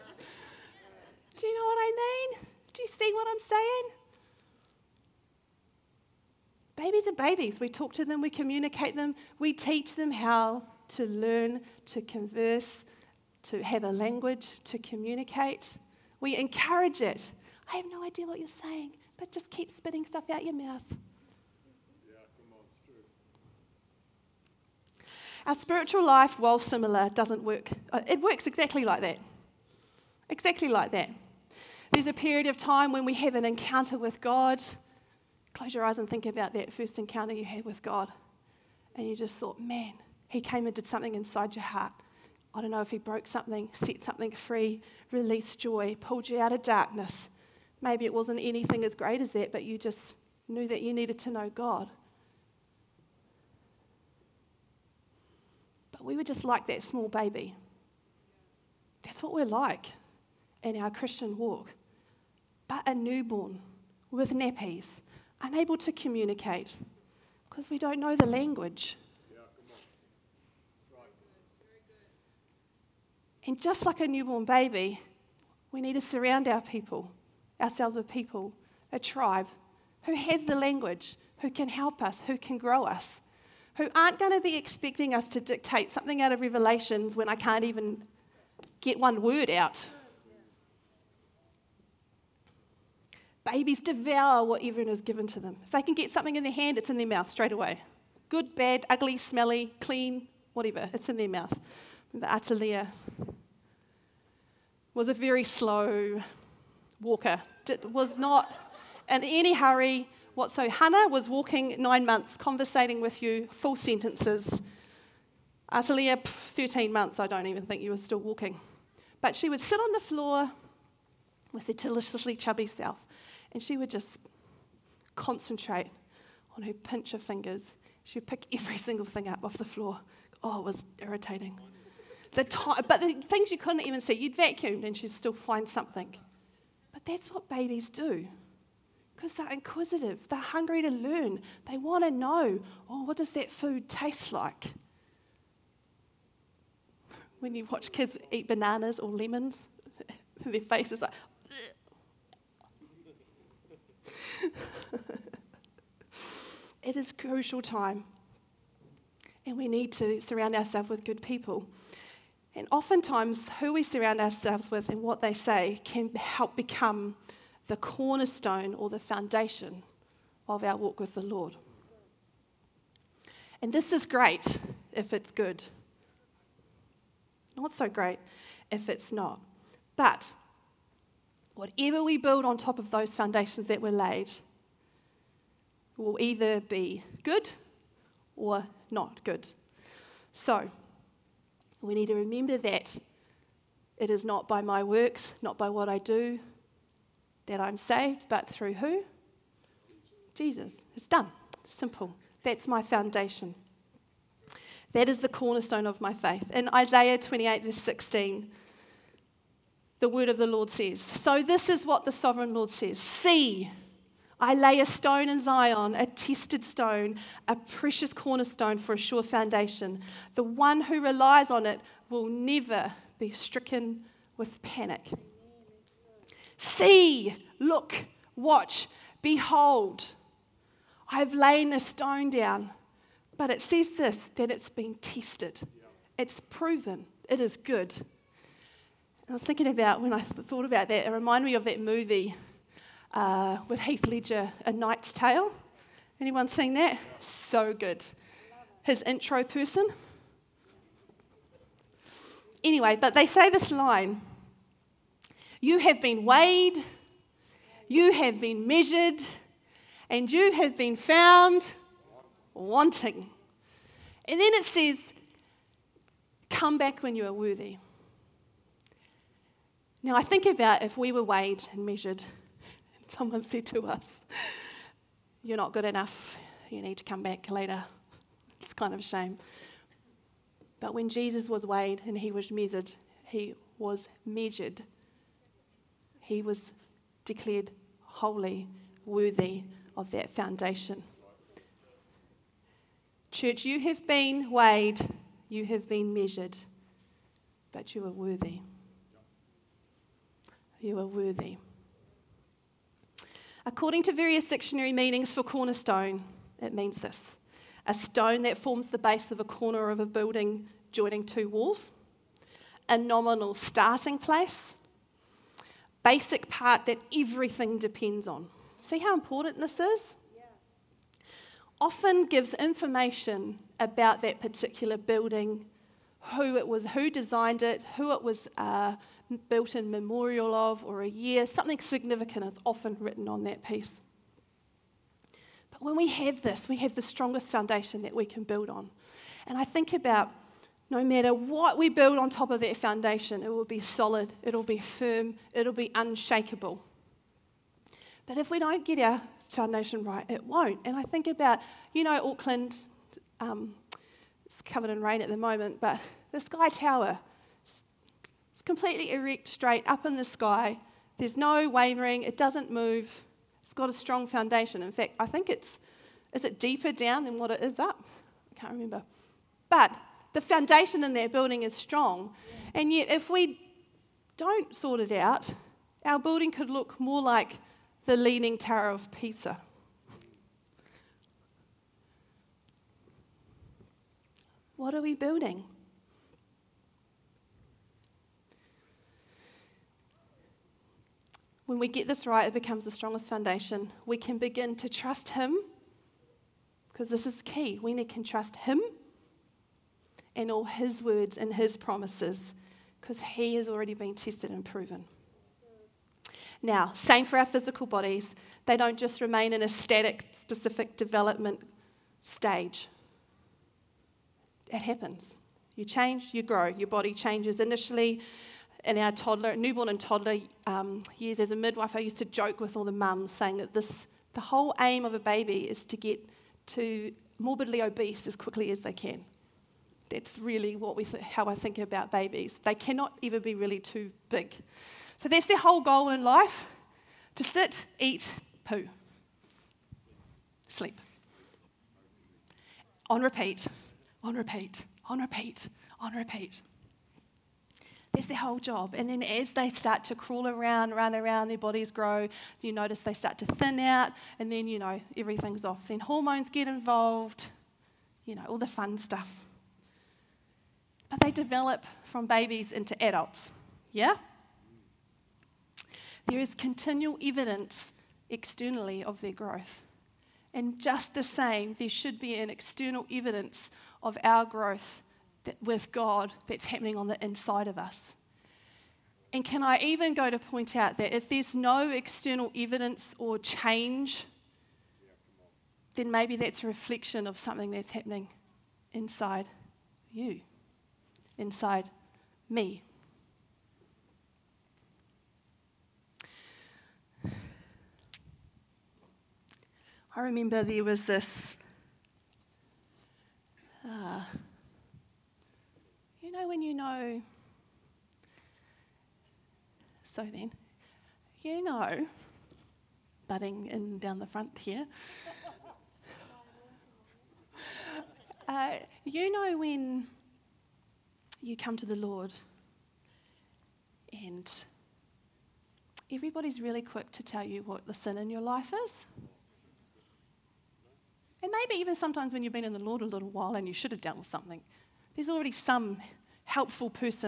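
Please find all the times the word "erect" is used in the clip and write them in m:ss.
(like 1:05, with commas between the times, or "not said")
5:59.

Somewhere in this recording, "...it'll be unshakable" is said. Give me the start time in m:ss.
5:45.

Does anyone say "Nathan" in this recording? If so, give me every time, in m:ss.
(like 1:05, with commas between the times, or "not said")
not said.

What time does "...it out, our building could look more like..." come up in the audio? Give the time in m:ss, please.
6:15.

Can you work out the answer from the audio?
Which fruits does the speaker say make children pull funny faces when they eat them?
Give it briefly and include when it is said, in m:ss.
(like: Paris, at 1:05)
Bananas or lemons, at 2:28.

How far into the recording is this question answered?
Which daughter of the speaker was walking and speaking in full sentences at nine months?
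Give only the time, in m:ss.
1:50.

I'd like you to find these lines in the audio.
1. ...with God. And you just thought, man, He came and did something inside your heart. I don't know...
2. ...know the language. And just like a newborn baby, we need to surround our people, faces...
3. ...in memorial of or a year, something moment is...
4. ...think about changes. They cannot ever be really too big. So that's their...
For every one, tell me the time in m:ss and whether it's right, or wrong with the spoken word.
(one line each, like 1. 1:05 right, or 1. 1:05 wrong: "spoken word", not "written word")
1. 0:37 right
2. 1:07 wrong: "ourselves", not "faces"
3. 5:29 wrong: "significant", not "moment"
4. 7:11 wrong: "babies", not "changes".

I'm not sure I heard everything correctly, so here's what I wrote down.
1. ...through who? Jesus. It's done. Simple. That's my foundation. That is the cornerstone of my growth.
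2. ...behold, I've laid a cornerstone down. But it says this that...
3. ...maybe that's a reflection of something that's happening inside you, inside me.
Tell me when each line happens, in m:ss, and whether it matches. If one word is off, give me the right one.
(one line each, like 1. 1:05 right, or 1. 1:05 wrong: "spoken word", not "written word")
1. 3:18 wrong: "faith", not "growth"
2. 3:49 wrong: "stone", not "cornerstone"
3. 8:06 right.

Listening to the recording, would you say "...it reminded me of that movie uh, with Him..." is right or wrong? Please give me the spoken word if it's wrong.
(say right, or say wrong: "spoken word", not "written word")
wrong: "Heath", not "Him".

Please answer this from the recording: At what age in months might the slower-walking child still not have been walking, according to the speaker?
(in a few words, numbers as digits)
13.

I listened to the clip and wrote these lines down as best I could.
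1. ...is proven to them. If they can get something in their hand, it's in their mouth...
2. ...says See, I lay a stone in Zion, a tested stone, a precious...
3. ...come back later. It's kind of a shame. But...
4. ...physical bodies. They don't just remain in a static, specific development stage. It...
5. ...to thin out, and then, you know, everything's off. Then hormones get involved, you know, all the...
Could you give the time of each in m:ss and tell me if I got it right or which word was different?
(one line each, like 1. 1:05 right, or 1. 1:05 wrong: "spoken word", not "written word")
1. 1:34 wrong: "given", not "proven"
2. 3:32 right
3. 4:37 right
4. 6:47 right
5. 7:33 right.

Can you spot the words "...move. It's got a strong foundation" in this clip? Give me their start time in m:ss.
6:02.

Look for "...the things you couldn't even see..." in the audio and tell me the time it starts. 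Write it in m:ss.
2:13.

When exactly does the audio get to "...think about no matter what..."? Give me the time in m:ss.
5:39.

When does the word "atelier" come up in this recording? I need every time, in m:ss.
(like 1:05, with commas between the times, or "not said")
1:42, 1:55.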